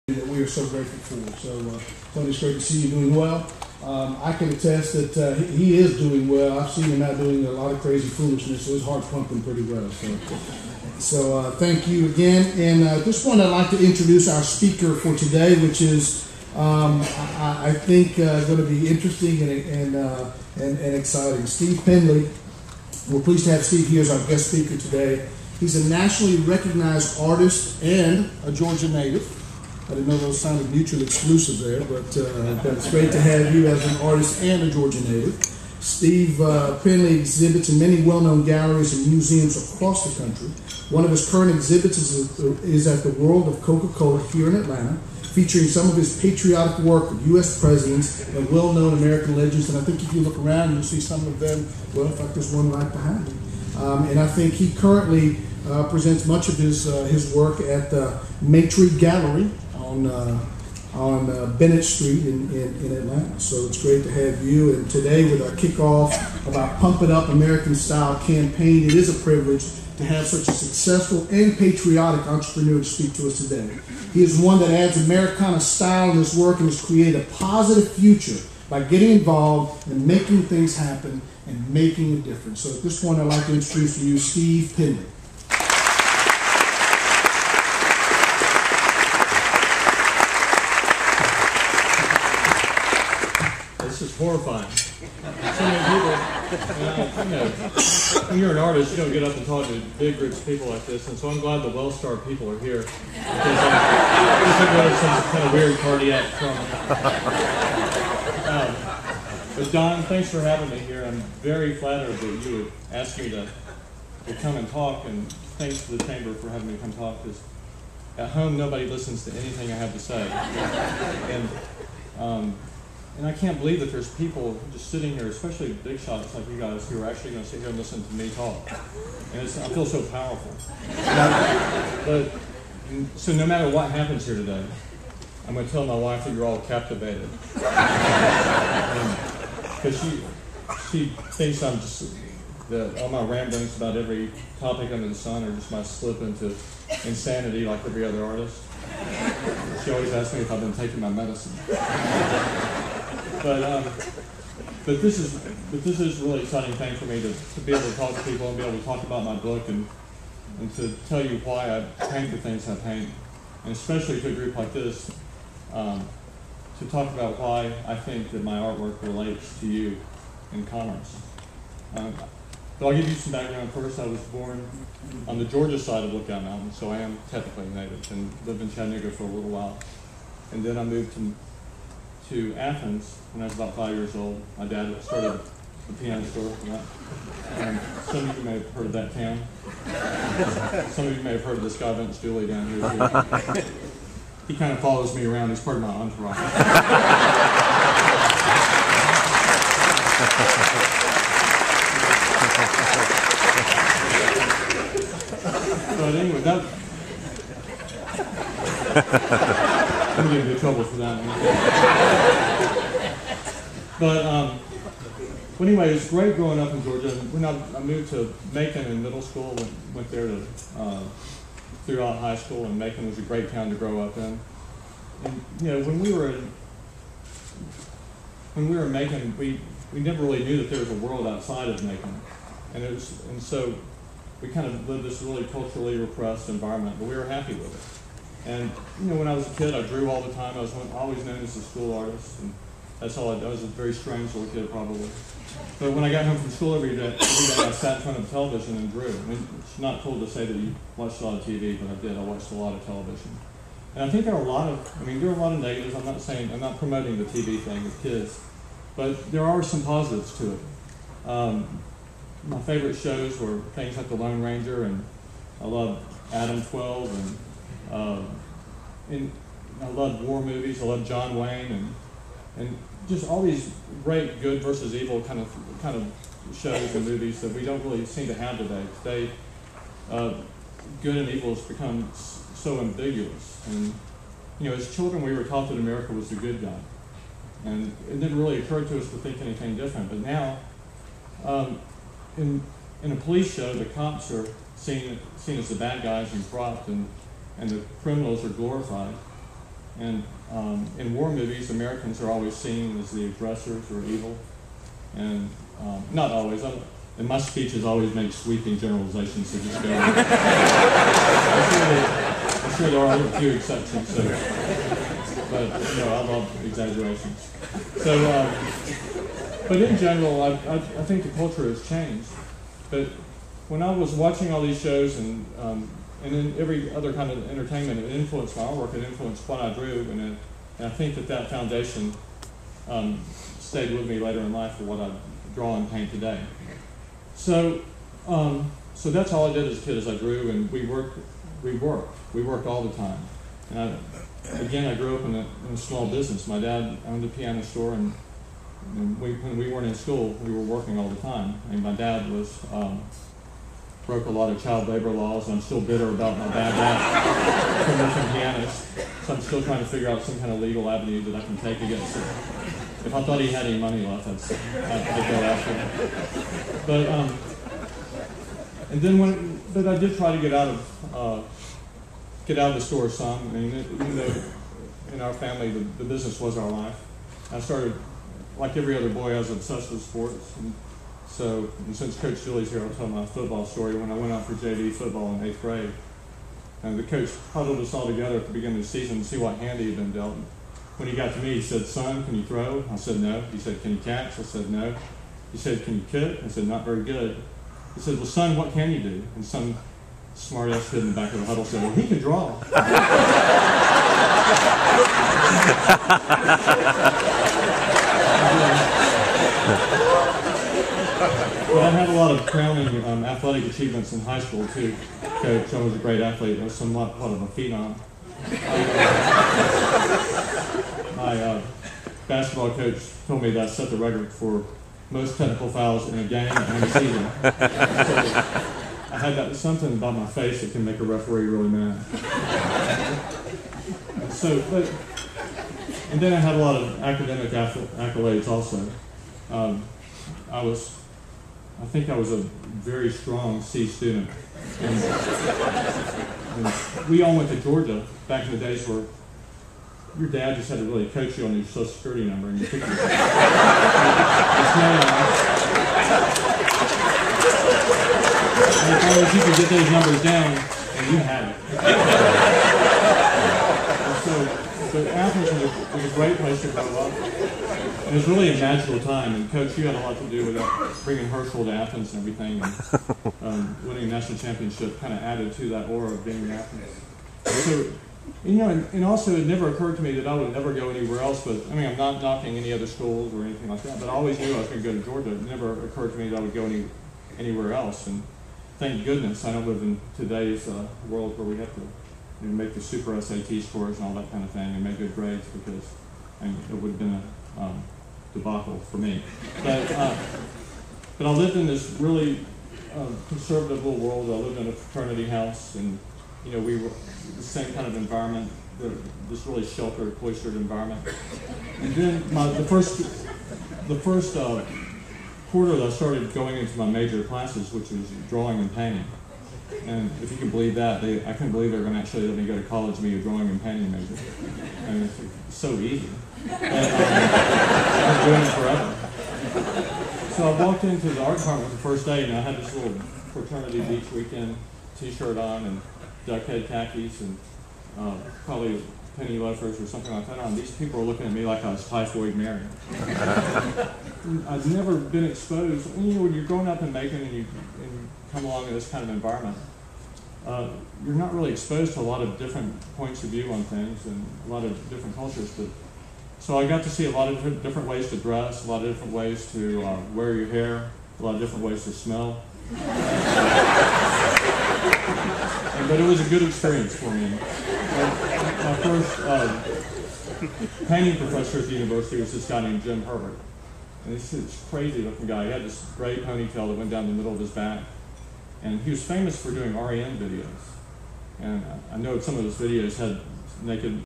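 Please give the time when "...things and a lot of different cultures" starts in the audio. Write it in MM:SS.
09:13.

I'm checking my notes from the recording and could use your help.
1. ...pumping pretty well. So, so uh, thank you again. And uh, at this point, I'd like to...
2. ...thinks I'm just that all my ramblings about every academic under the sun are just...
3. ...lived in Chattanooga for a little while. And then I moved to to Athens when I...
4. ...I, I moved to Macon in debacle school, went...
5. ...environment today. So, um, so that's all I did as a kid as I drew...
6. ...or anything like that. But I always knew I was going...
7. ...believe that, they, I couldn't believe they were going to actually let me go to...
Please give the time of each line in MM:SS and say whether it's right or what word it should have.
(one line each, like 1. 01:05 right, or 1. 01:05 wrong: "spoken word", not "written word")
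1. 00:09 right
2. 02:21 wrong: "topic", not "academic"
3. 02:58 right
4. 03:37 wrong: "middle", not "debacle"
5. 05:35 wrong: "paint", not "environment"
6. 08:03 right
7. 08:40 right.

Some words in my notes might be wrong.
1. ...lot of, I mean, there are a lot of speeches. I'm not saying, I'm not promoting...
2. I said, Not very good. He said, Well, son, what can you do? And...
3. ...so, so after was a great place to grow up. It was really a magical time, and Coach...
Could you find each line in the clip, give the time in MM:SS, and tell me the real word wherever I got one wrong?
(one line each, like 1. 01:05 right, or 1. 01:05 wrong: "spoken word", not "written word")
1. 04:14 wrong: "negatives", not "speeches"
2. 06:36 right
3. 07:44 right.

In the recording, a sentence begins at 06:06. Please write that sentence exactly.
But um, and then when, but I did try to get out of uh, get out of the store some.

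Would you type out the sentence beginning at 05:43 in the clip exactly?
And I, again, I grew up in a, in a small business.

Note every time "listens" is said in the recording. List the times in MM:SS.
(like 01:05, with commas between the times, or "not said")
01:58, 02:07.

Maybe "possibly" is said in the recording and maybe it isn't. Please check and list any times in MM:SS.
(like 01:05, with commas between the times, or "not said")
not said.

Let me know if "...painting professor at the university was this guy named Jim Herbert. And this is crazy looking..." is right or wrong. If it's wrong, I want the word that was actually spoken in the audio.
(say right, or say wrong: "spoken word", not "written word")
right.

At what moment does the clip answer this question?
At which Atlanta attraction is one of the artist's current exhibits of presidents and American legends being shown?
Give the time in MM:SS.
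00:43.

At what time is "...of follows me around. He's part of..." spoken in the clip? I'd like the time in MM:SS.
03:14.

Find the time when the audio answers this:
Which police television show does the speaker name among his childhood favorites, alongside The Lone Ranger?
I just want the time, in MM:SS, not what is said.
04:26.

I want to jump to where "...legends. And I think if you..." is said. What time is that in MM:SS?
00:49.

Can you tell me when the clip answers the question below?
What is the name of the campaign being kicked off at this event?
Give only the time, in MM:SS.
01:06.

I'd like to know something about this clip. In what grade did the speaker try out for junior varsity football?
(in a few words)
eighth grade.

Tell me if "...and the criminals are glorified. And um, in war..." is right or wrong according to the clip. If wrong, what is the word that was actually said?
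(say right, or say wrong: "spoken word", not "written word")
right.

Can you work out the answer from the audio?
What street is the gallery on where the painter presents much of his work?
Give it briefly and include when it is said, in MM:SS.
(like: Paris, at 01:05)
Bennett Street, at 01:01.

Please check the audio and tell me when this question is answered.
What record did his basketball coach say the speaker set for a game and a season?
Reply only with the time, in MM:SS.
07:05.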